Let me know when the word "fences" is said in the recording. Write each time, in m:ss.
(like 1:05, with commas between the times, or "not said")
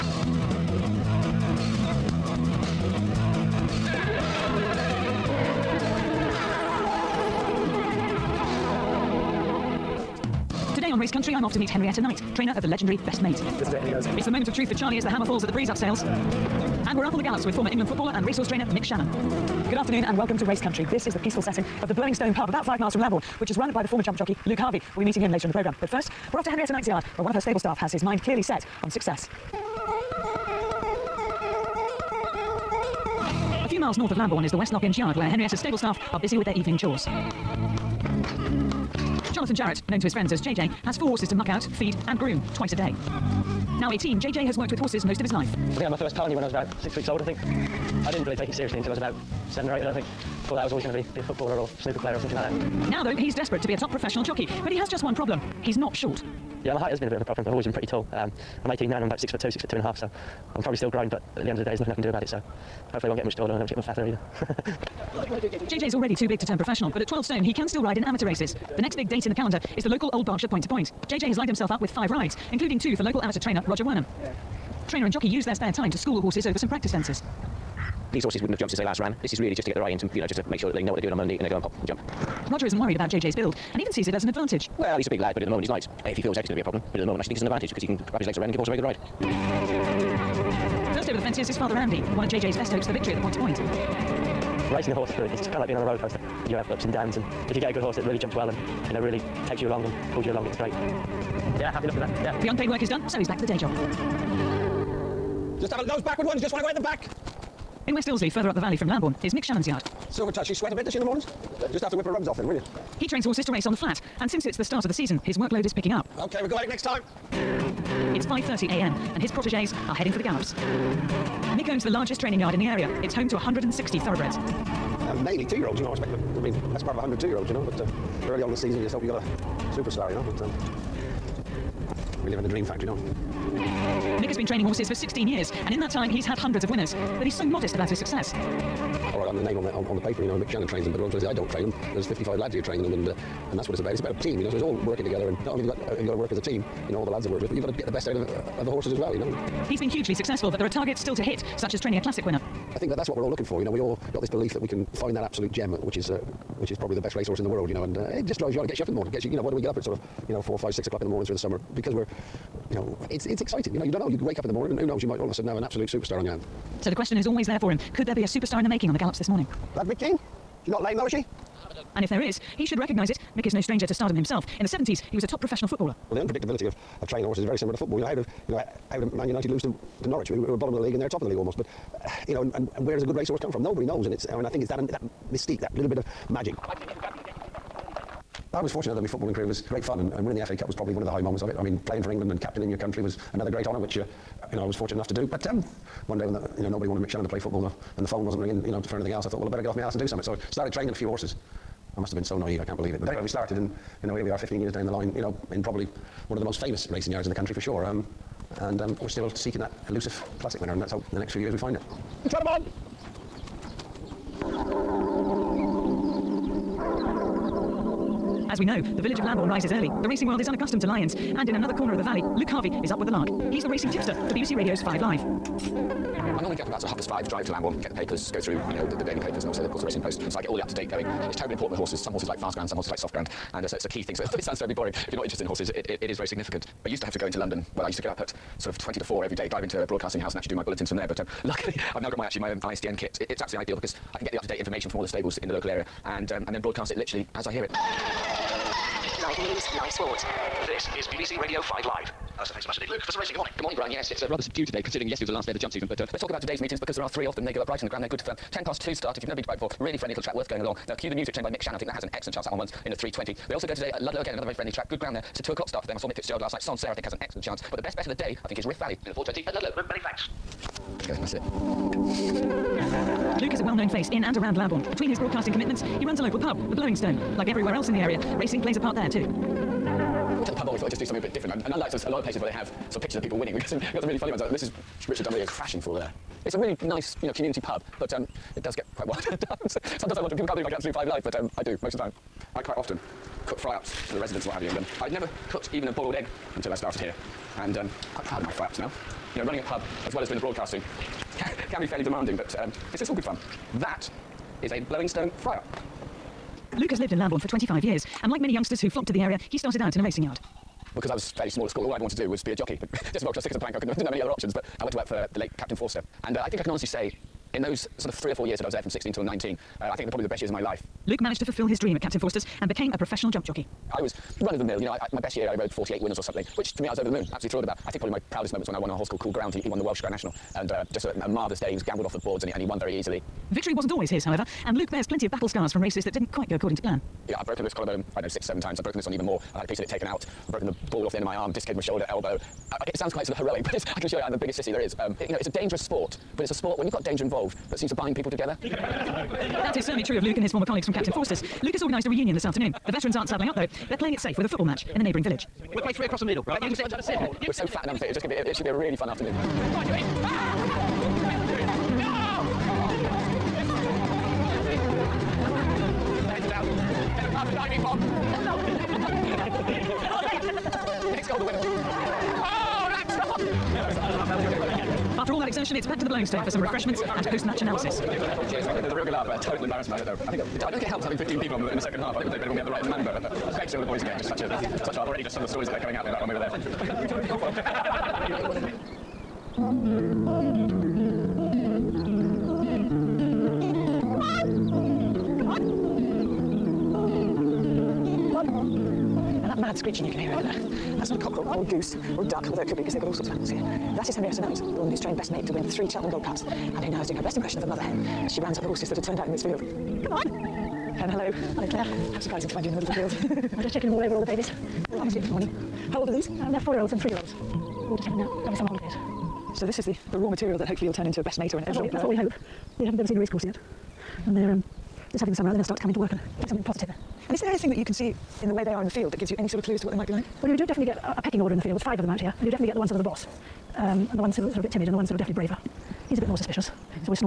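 1:16, 1:31.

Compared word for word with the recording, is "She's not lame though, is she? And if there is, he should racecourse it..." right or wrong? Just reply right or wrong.
wrong.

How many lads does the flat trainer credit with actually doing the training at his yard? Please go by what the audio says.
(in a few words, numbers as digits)
55.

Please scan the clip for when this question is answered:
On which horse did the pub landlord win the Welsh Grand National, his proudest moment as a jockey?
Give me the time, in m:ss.
5:29.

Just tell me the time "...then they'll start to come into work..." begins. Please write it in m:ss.
7:05.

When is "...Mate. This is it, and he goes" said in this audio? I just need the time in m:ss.
0:13.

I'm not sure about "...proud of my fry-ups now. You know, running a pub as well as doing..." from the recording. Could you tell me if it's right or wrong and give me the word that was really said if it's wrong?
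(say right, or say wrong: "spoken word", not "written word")
right.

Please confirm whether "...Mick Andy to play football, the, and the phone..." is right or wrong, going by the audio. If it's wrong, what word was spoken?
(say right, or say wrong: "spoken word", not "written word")
wrong: "Channon", not "Andy".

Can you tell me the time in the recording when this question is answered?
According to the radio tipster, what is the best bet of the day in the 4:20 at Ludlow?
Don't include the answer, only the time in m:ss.
4:28.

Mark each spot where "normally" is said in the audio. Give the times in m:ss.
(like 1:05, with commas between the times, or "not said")
3:46.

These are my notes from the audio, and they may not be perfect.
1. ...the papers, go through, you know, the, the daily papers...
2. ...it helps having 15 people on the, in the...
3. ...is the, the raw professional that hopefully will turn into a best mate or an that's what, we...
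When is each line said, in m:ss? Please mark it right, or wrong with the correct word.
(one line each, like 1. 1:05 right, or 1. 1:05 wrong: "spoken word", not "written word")
1. 3:47 right
2. 6:20 right
3. 6:59 wrong: "material", not "professional".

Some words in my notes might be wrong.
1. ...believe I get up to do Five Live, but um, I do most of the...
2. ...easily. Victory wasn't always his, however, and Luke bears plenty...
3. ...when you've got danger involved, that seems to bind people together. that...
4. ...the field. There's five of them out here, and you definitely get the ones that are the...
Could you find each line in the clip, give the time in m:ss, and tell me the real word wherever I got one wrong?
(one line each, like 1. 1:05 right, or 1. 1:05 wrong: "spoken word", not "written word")
1. 4:50 right
2. 5:32 right
3. 5:46 right
4. 7:11 right.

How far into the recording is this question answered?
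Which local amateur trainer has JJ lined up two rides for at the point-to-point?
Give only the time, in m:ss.
1:13.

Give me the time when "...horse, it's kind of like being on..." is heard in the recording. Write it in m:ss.
1:34.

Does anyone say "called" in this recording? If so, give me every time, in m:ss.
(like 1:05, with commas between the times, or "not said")
5:29.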